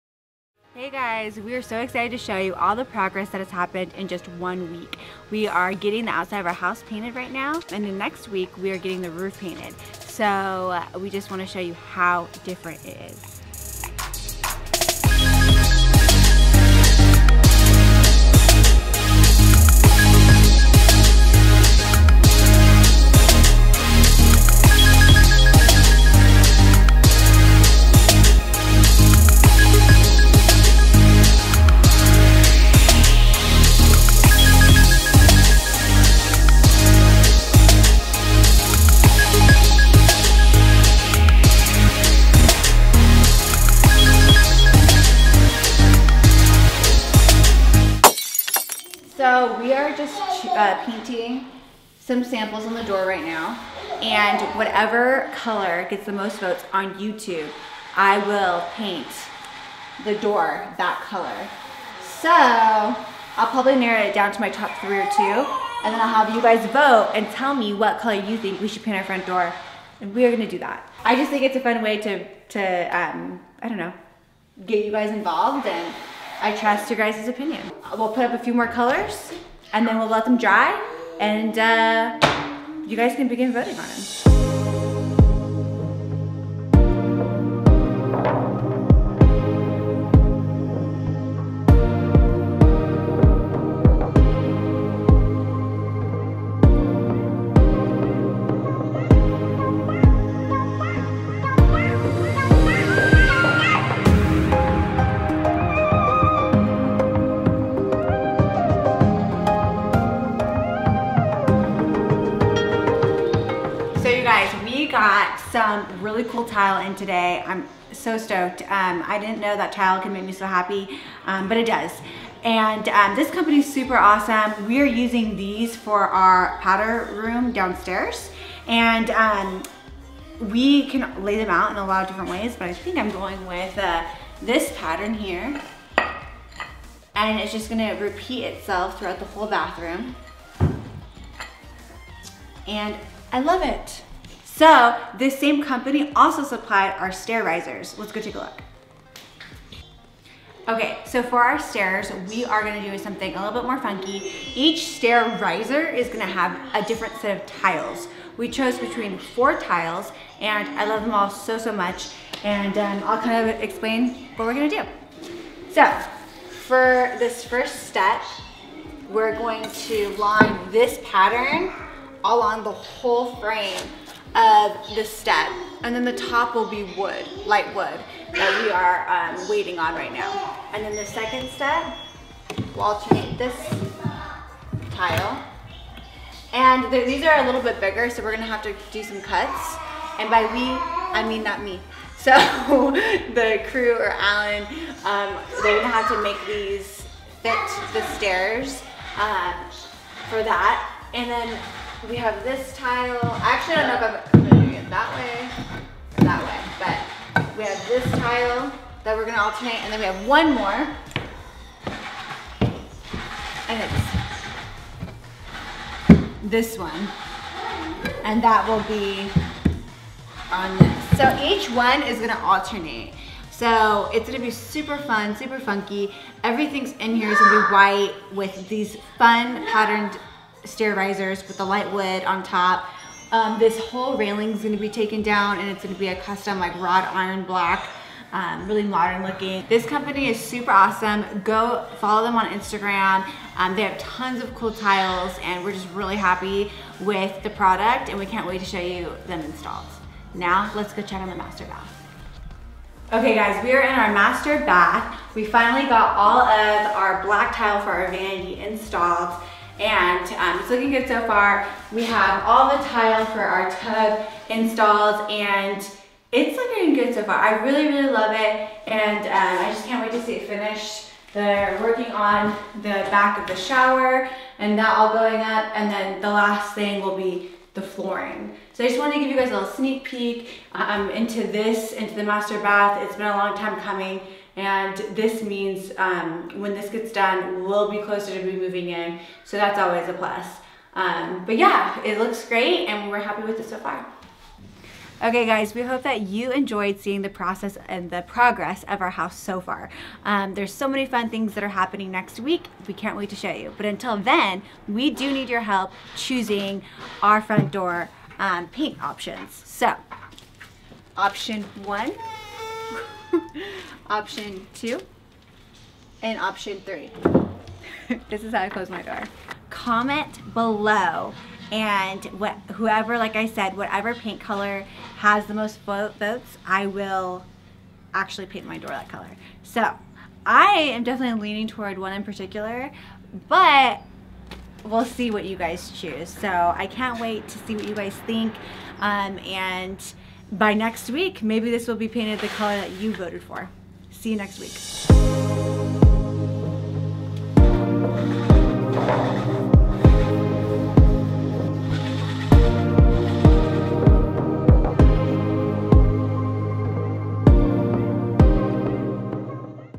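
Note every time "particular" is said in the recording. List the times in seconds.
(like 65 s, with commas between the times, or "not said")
332 s.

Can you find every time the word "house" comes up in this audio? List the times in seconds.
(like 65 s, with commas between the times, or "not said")
6 s, 299 s.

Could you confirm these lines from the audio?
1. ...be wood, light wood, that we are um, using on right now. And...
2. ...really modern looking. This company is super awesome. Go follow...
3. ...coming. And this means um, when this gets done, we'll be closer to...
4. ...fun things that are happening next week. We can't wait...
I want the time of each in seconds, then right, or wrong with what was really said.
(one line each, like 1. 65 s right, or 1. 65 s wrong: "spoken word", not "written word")
1. 176 s wrong: "waiting", not "using"
2. 238 s right
3. 283 s right
4. 301 s right.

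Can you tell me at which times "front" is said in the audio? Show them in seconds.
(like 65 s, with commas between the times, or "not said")
69 s, 307 s.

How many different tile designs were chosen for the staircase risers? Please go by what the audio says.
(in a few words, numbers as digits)
4.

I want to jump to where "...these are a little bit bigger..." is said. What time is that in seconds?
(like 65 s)
186 s.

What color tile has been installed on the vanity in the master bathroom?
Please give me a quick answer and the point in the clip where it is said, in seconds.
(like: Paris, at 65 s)
Black, at 257 s.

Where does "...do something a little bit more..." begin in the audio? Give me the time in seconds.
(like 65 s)
152 s.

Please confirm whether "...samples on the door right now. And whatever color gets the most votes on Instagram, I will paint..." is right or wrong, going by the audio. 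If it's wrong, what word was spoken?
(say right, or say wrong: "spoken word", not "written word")
wrong: "YouTube", not "Instagram".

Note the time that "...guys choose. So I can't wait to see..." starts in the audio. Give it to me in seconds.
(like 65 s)
335 s.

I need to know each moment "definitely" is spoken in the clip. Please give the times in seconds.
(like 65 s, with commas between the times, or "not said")
331 s.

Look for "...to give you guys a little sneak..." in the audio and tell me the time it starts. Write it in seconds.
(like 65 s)
279 s.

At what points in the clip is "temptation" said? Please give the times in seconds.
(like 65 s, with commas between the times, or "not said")
not said.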